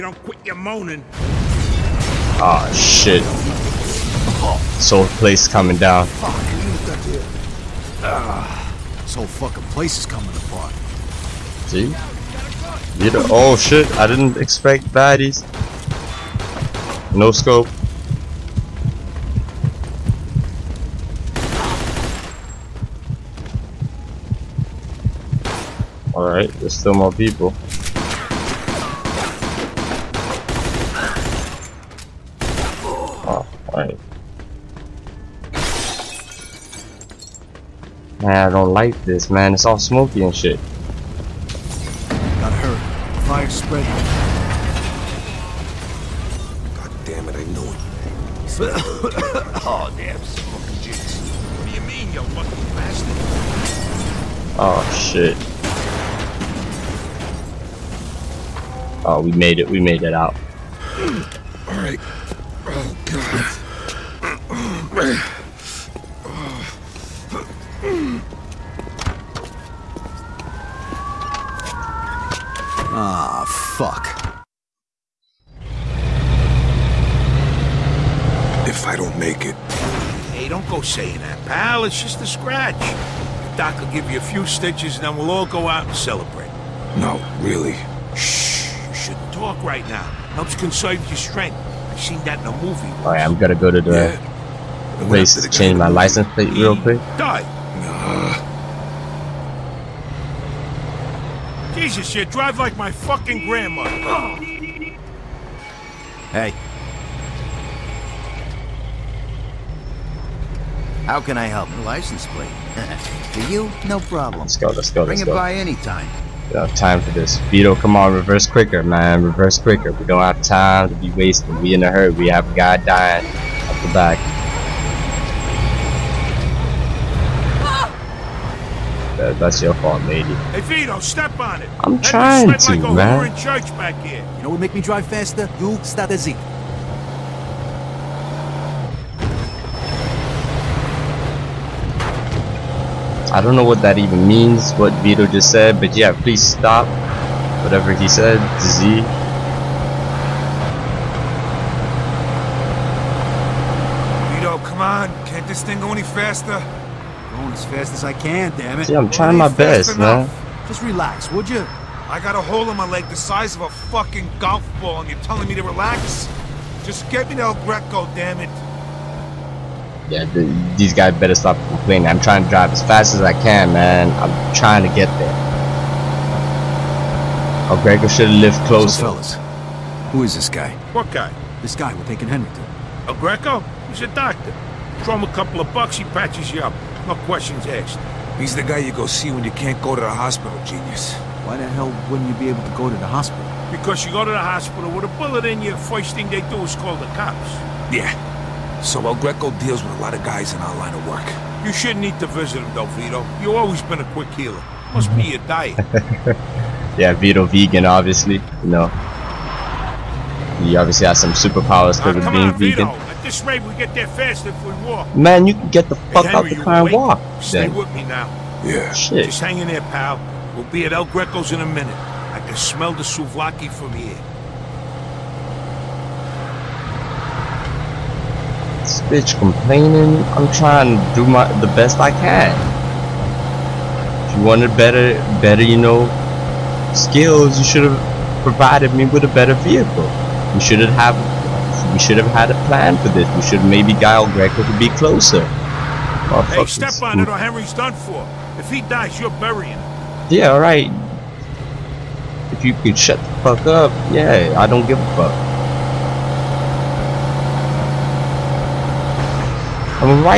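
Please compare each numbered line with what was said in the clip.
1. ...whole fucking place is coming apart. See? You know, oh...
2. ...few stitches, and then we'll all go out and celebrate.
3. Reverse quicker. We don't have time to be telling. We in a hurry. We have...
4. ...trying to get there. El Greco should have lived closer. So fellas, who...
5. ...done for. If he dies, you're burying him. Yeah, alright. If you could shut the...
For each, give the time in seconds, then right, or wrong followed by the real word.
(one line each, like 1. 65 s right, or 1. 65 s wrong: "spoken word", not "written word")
1. 9 s right
2. 84 s right
3. 119 s wrong: "wasting", not "telling"
4. 174 s right
5. 247 s right.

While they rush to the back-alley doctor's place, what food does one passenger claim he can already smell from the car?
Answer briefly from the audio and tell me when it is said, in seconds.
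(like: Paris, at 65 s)
souvlaki, at 223 s.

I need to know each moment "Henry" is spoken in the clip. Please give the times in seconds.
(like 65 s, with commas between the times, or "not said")
182 s, 247 s.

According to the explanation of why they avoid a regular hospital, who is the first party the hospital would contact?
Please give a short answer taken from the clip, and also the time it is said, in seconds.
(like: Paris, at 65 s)
the cops, at 197 s.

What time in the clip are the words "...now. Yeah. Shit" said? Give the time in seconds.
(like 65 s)
218 s.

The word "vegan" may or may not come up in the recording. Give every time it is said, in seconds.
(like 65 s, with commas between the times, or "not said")
207 s, 212 s.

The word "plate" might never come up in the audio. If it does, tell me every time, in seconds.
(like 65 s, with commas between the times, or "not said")
96 s, 112 s.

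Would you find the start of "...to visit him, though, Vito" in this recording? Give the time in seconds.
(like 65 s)
202 s.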